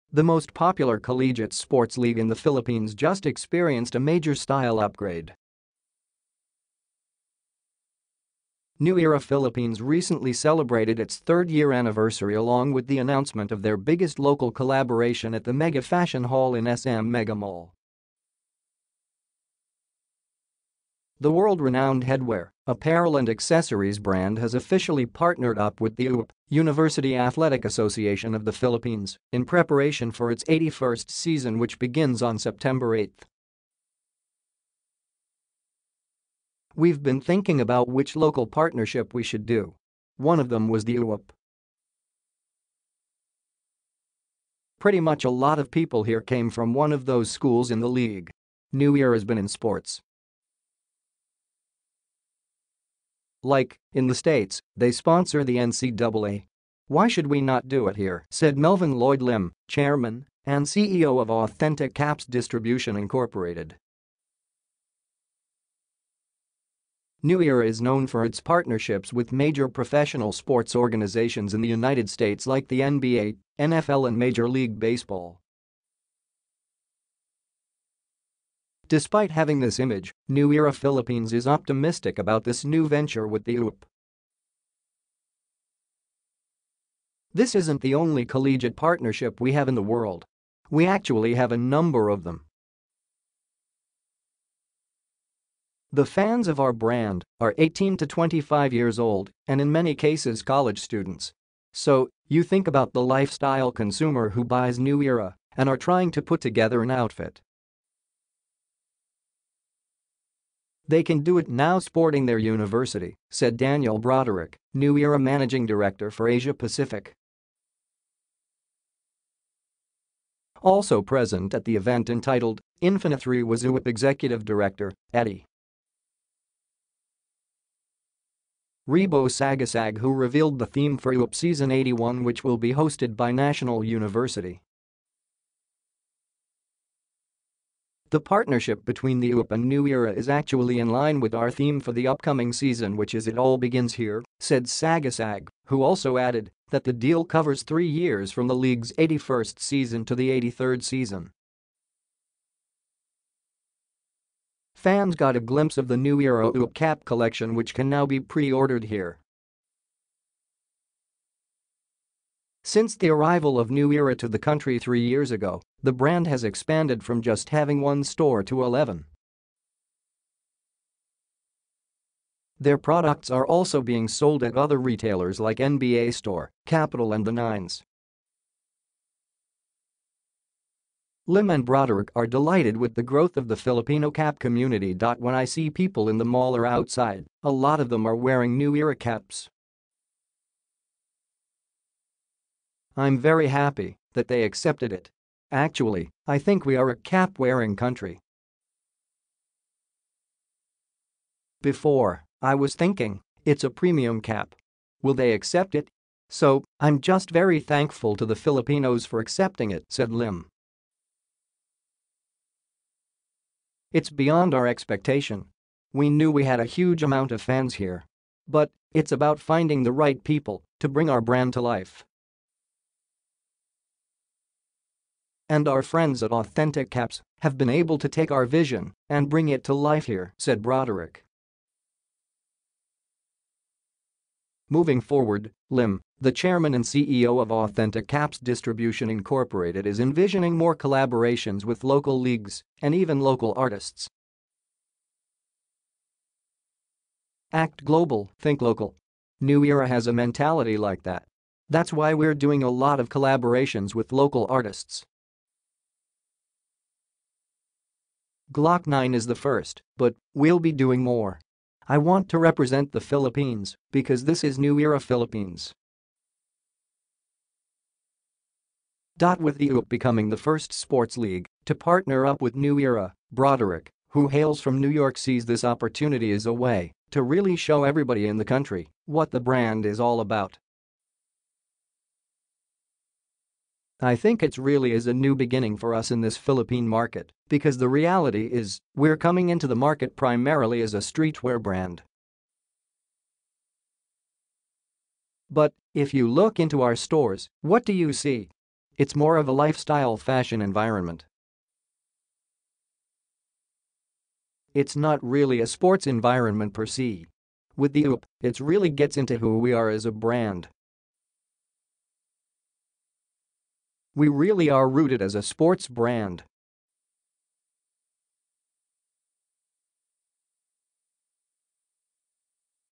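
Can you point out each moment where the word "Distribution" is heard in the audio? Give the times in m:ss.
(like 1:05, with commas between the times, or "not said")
1:02, 3:58.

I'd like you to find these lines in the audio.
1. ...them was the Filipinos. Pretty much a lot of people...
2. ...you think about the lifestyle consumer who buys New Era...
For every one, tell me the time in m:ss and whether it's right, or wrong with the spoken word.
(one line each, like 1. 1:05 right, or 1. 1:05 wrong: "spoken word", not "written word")
1. 0:40 wrong: "UAAP", not "Filipinos"
2. 1:42 right.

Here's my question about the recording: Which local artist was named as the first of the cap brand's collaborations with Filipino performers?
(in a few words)
Gloc-9.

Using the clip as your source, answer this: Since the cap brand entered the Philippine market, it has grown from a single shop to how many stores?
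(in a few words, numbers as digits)
11.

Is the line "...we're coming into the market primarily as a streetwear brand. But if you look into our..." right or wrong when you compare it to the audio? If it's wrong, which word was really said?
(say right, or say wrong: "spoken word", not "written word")
right.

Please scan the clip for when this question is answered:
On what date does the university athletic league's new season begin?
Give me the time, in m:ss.
0:32.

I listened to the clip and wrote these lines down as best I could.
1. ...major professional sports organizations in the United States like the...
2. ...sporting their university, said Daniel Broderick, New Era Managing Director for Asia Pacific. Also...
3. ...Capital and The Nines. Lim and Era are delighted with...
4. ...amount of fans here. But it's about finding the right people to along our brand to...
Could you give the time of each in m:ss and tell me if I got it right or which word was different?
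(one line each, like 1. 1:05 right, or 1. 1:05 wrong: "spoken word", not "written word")
1. 1:09 right
2. 1:51 right
3. 2:56 wrong: "Broderick", not "Era"
4. 3:37 wrong: "bring", not "along".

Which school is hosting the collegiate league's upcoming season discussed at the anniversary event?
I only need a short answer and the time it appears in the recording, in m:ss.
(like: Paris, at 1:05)
National University, at 2:13.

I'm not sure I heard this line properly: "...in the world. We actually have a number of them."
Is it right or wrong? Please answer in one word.
right.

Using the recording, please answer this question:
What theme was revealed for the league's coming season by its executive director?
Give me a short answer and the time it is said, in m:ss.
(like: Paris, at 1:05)
It All Begins Here, at 2:23.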